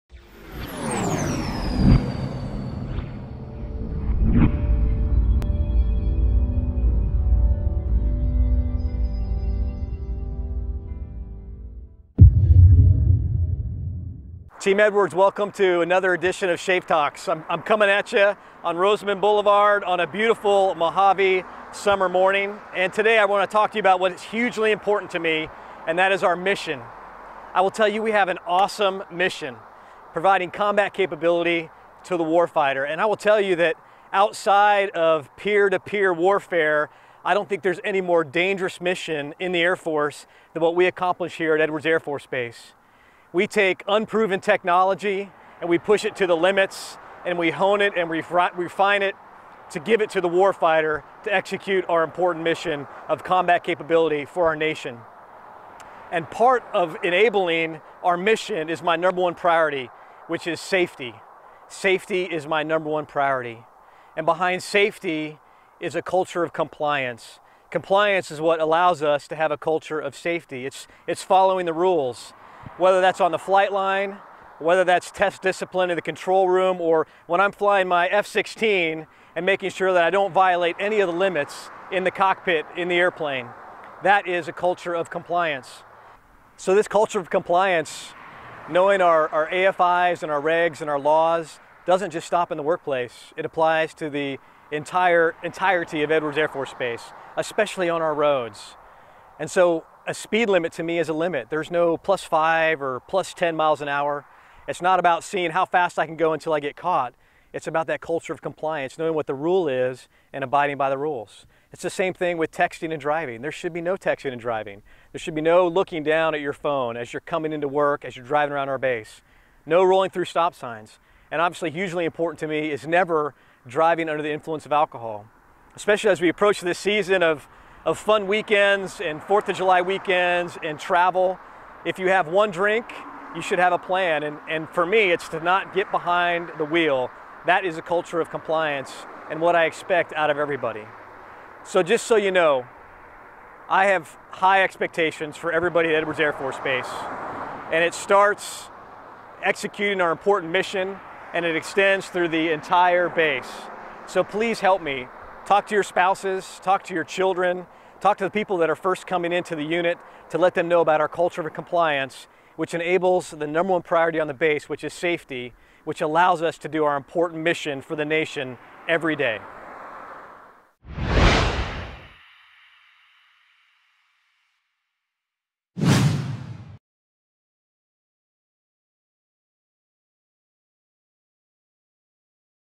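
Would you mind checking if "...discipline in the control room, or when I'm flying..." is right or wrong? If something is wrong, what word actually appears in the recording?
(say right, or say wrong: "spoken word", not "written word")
right.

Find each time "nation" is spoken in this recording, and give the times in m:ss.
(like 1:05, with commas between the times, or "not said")
0:54, 2:48.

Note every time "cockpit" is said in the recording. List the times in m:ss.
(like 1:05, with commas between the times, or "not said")
1:22.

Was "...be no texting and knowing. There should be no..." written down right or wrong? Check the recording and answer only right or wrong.
wrong.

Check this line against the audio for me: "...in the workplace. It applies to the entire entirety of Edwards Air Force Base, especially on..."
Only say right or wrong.
right.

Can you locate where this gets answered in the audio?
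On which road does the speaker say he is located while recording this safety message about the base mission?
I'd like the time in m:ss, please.
0:18.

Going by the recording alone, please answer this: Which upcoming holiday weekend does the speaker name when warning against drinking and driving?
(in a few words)
4th of July.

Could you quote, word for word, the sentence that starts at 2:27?
And it starts executing our important mission and it extends through the entire base.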